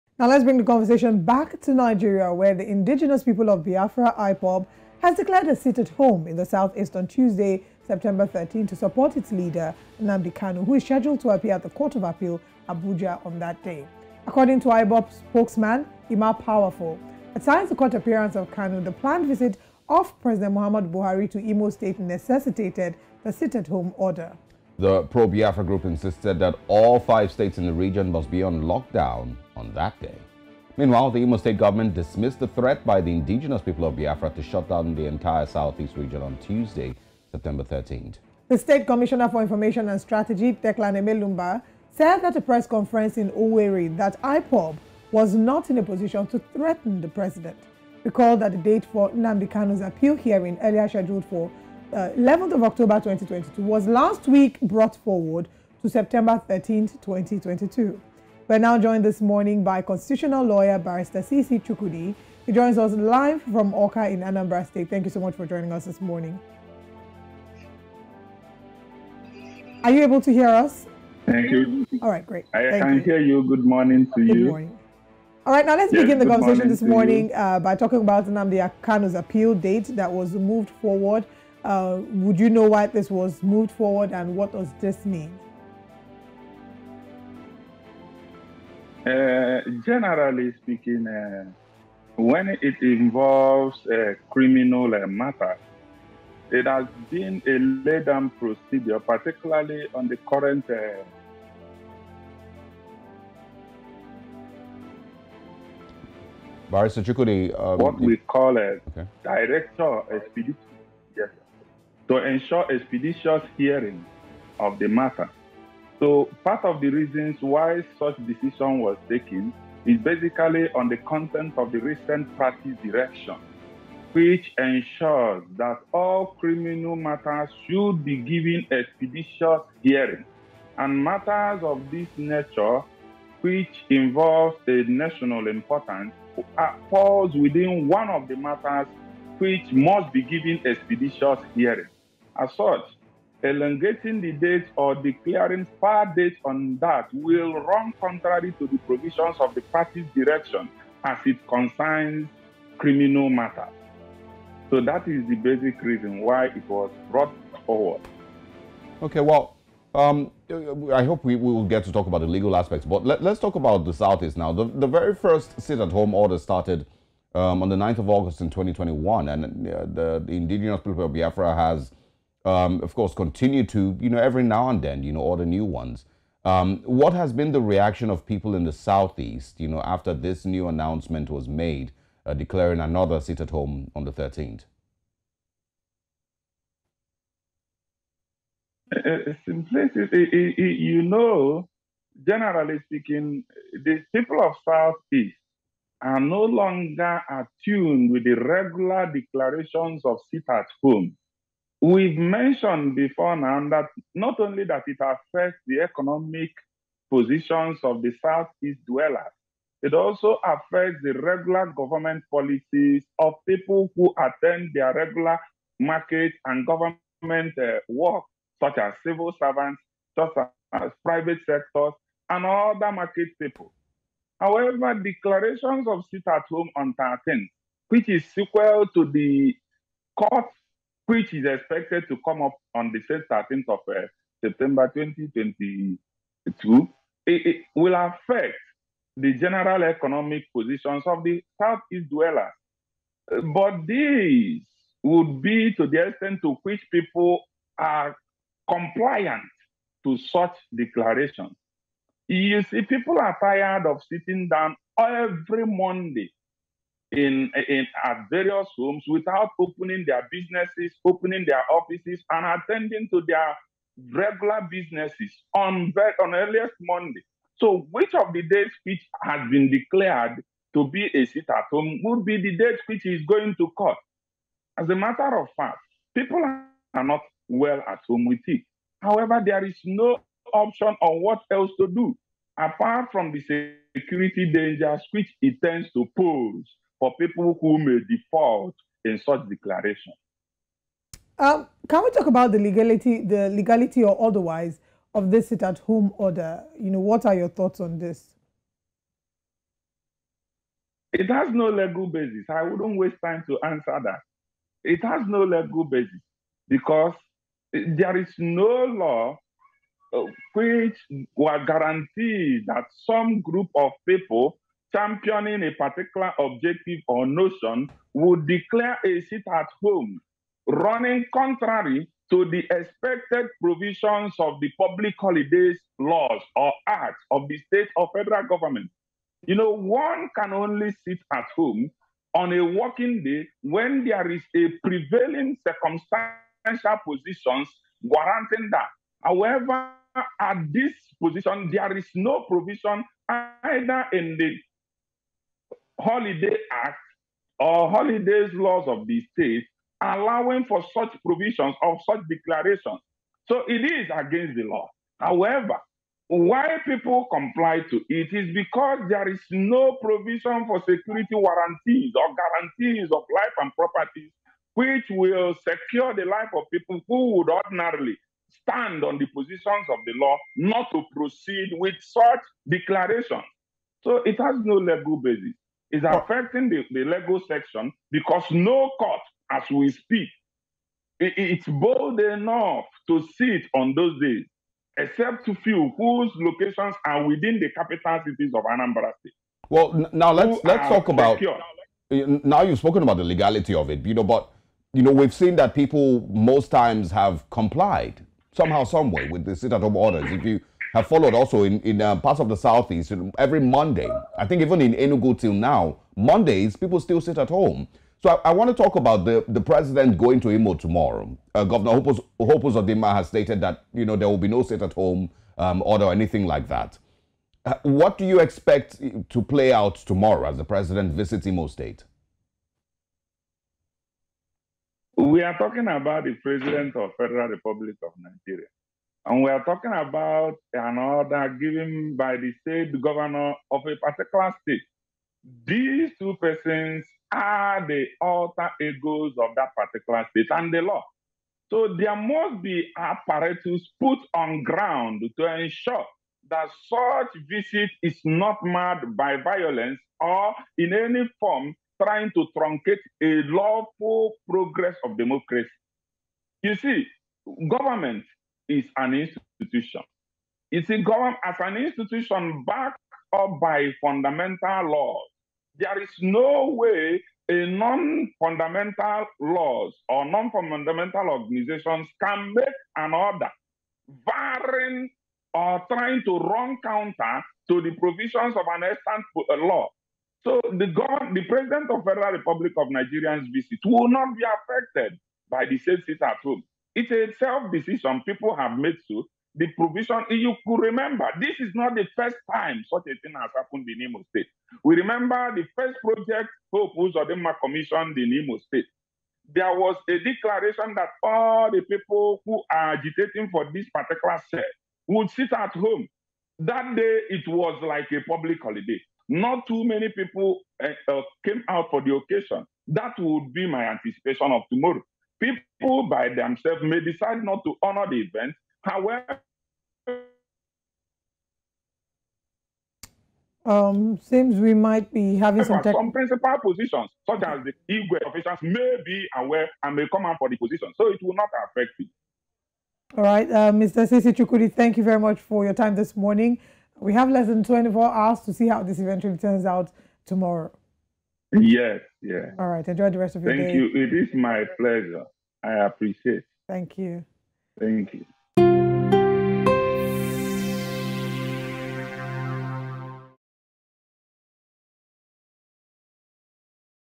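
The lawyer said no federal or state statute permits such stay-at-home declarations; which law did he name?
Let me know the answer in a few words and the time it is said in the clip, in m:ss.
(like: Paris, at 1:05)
Holiday Act, at 5:46.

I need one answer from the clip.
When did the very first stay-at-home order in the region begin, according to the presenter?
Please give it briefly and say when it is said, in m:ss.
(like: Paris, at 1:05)
9 August 2021, at 2:47.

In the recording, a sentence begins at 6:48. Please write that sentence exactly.
So I, I want to talk about the, the president going to Imo tomorrow.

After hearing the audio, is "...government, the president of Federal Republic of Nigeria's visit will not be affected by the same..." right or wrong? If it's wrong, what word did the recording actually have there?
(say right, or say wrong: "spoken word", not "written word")
right.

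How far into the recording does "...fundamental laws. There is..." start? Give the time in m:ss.
7:44.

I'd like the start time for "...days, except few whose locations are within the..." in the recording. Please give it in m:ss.
6:24.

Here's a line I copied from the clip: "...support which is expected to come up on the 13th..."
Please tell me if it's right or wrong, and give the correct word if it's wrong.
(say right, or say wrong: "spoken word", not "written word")
wrong: "court", not "support".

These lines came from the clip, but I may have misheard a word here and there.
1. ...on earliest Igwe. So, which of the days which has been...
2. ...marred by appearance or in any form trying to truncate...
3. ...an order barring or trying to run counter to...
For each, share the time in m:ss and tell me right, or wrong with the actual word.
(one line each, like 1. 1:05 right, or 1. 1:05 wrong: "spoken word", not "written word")
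1. 4:26 wrong: "Monday", not "Igwe"
2. 7:28 wrong: "violence", not "appearance"
3. 7:52 right.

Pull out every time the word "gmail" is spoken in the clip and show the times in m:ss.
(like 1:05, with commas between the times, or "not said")
not said.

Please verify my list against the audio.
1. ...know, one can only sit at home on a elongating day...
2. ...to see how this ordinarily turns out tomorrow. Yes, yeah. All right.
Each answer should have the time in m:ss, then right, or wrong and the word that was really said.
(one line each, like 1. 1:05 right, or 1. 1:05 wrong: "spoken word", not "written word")
1. 5:29 wrong: "working", not "elongating"
2. 8:58 wrong: "eventually", not "ordinarily".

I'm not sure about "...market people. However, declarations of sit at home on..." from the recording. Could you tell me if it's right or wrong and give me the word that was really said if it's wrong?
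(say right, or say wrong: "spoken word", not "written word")
right.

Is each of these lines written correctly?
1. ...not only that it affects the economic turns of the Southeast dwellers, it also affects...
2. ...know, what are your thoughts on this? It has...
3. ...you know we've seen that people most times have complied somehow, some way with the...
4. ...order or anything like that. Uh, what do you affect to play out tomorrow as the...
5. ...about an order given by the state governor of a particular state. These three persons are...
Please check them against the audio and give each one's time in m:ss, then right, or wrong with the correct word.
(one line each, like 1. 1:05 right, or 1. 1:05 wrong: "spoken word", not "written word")
1. 3:24 wrong: "positions", not "turns"
2. 4:56 right
3. 6:34 right
4. 6:55 wrong: "expect", not "affect"
5. 7:09 wrong: "two", not "three".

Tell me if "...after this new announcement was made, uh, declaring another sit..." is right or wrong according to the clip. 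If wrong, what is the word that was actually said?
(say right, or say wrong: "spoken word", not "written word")
right.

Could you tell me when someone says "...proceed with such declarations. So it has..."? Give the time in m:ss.
6:11.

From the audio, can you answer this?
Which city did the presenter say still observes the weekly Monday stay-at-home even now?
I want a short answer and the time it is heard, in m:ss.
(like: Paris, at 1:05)
Enugu, at 6:44.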